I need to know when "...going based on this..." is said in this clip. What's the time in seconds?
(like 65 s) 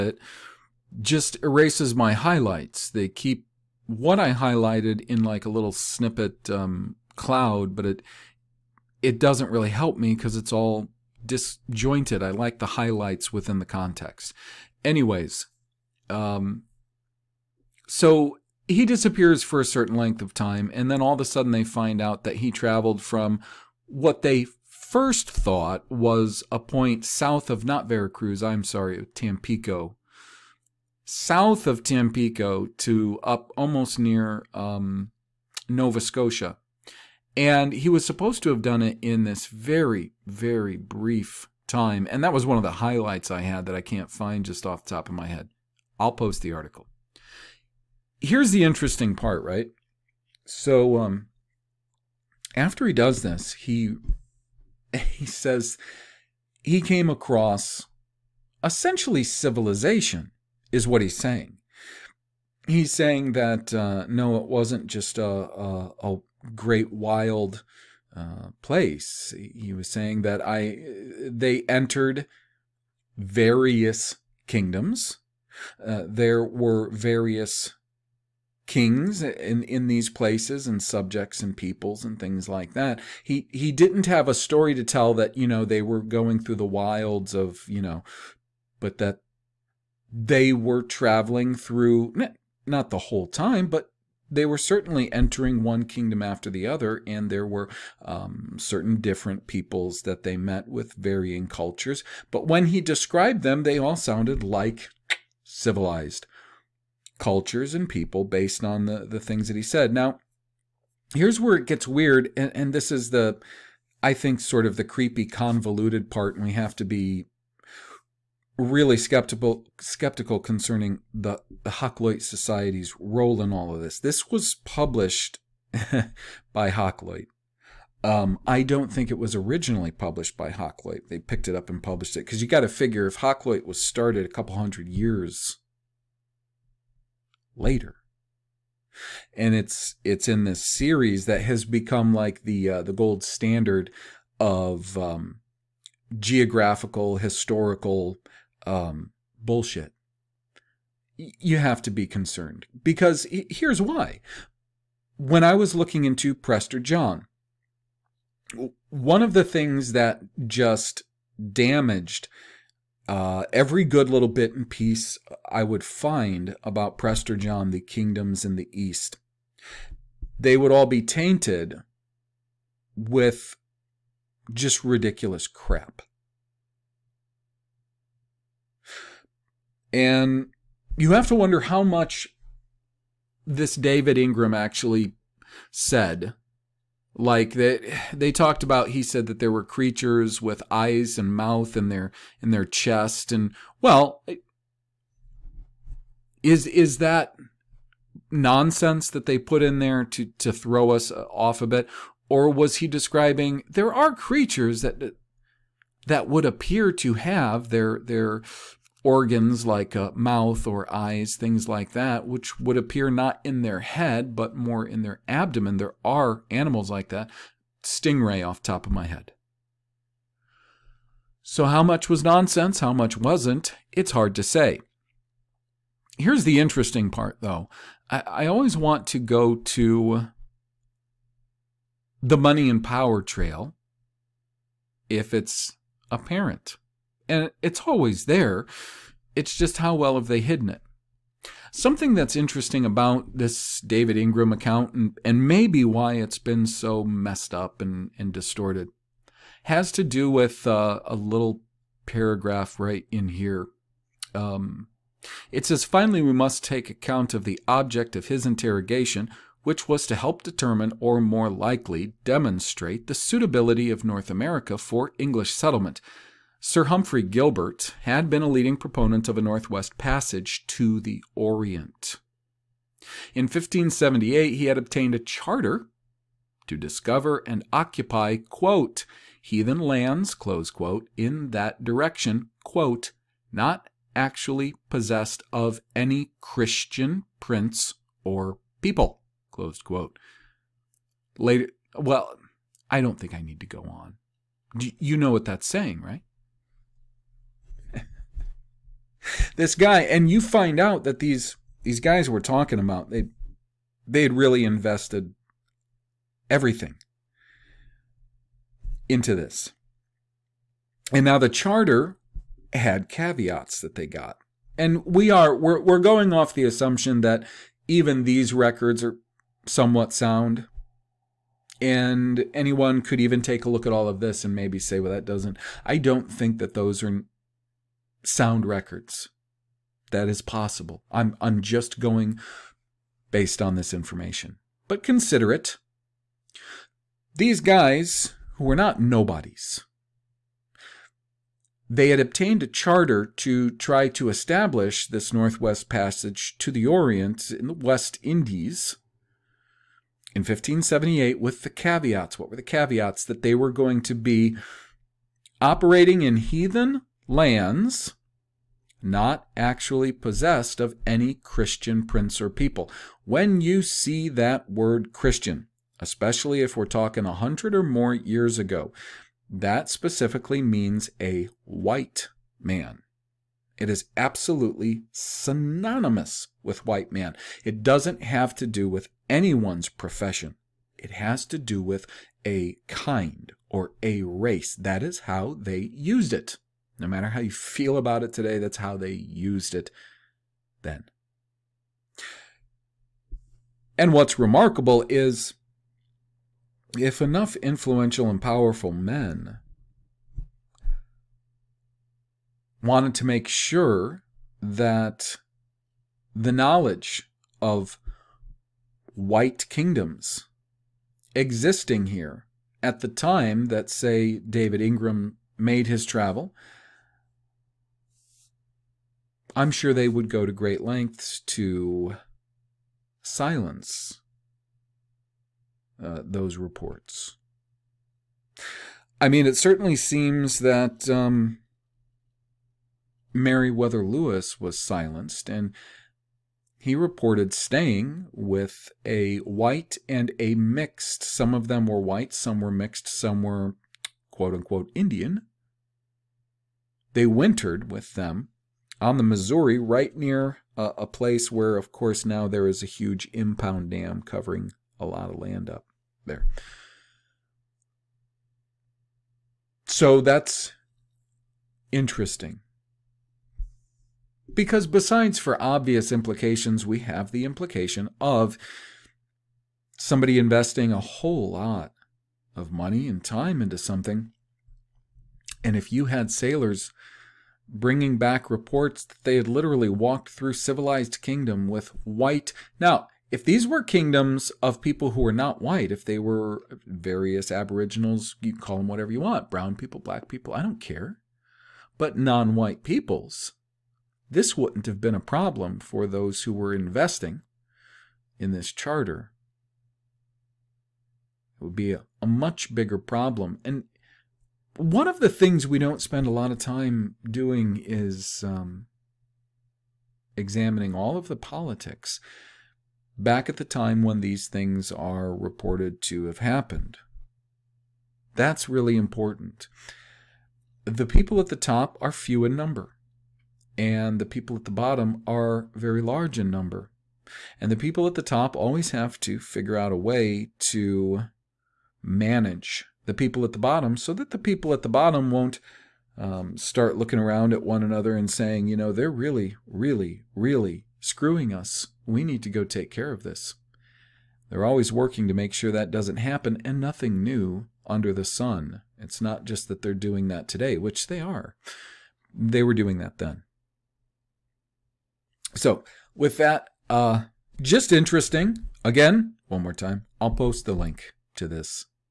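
331 s.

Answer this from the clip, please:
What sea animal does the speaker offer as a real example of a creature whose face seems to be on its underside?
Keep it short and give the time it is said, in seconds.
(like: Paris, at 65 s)
Stingray, at 217 s.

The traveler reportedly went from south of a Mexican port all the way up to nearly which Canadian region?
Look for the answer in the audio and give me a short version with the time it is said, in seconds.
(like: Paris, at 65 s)
Nova Scotia, at 35 s.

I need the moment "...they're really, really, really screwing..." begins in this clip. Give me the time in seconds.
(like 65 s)
538 s.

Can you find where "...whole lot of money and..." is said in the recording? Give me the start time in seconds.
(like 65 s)
470 s.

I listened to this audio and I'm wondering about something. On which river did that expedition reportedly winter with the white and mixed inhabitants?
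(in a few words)
Missouri.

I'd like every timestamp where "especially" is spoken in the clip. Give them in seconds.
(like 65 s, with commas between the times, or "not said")
365 s.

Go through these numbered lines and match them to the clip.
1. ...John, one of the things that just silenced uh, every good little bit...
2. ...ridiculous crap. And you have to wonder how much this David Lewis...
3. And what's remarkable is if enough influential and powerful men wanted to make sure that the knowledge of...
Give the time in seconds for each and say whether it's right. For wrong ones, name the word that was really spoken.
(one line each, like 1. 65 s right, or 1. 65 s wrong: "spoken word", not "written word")
1. 156 s wrong: "damaged", not "silenced"
2. 174 s wrong: "Ingram", not "Lewis"
3. 393 s right.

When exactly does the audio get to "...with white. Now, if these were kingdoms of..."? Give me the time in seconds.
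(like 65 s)
481 s.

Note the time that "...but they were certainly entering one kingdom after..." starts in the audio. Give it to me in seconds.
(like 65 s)
93 s.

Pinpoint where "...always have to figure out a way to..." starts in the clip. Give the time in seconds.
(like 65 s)
528 s.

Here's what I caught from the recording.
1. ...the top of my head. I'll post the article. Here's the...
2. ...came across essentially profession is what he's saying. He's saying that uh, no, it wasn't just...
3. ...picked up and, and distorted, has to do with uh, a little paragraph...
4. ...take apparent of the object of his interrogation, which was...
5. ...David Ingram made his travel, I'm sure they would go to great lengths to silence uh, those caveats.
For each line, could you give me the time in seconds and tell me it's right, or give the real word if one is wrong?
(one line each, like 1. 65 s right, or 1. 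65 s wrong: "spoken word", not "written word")
1. 44 s right
2. 56 s wrong: "civilization", not "profession"
3. 247 s wrong: "messed", not "picked"
4. 256 s wrong: "account", not "apparent"
5. 414 s wrong: "reports", not "caveats".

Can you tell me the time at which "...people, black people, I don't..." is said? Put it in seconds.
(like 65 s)
489 s.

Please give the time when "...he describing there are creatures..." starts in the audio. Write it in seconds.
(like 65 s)
202 s.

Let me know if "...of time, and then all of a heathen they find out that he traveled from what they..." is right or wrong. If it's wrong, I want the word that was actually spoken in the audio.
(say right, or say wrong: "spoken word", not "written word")
wrong: "sudden", not "heathen".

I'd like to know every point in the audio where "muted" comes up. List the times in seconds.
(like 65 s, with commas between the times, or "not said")
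not said.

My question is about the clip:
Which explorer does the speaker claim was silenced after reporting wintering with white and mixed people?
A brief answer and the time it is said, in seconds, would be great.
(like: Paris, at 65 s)
Meriwether Lewis, at 433 s.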